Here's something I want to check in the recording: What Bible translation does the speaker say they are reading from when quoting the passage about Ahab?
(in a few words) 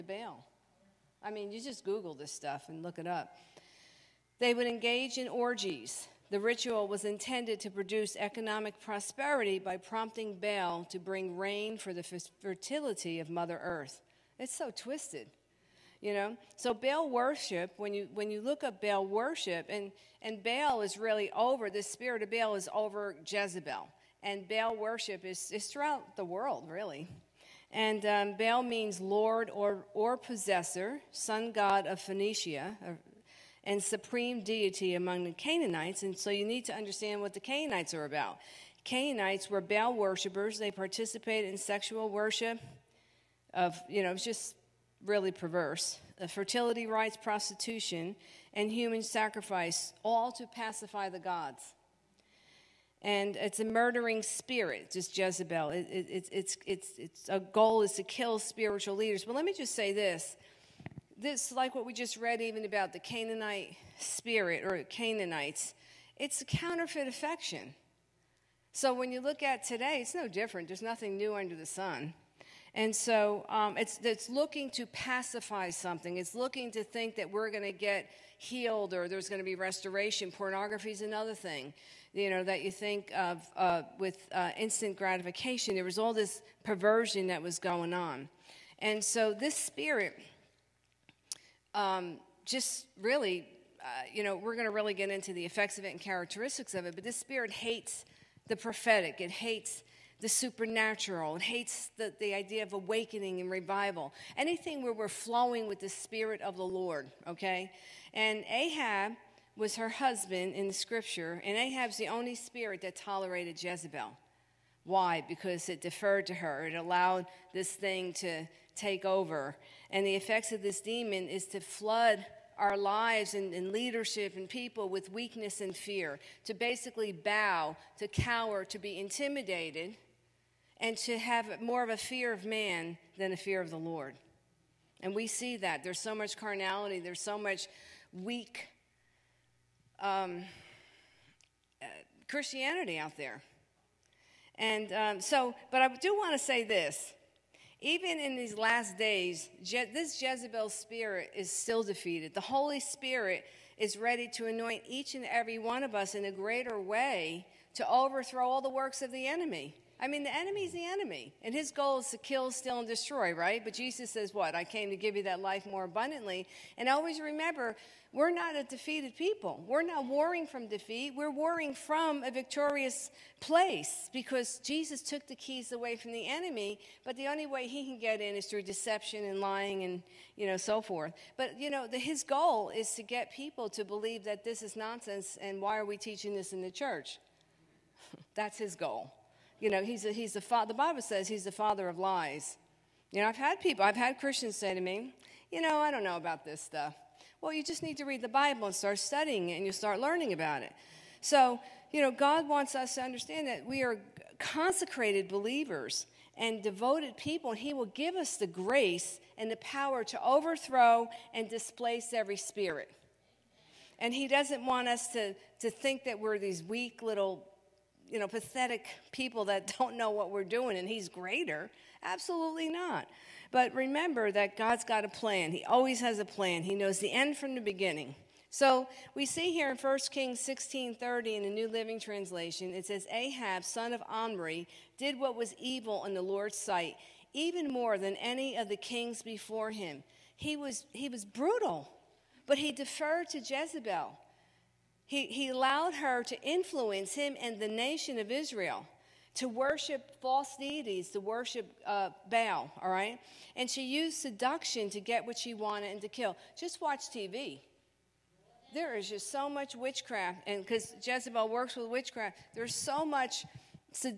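New Living Translation.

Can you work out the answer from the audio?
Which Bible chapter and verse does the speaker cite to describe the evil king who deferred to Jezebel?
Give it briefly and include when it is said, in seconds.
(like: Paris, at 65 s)
1 Kings 16:30, at 229 s.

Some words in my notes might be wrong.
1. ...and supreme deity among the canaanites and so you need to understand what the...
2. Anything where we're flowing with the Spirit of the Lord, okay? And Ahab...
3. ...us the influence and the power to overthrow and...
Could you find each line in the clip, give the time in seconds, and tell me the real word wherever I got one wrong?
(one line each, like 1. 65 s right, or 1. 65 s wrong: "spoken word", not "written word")
1. 33 s right
2. 104 s right
3. 208 s wrong: "grace", not "influence".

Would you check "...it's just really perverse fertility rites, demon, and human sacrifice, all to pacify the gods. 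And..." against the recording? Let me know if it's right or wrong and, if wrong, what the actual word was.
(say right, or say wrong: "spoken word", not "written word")
wrong: "prostitution", not "demon".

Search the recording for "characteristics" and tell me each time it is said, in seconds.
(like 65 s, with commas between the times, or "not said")
96 s.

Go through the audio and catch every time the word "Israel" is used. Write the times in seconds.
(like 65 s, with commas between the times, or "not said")
248 s.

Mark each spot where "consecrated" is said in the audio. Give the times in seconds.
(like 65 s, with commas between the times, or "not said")
204 s.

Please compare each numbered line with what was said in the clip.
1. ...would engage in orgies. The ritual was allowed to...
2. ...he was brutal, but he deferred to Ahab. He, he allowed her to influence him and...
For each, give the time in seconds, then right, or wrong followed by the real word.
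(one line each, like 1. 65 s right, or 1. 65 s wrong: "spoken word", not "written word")
1. 4 s wrong: "intended", not "allowed"
2. 240 s wrong: "Jezebel", not "Ahab".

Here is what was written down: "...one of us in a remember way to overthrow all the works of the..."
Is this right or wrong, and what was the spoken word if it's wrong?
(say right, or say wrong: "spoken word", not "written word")
wrong: "greater", not "remember".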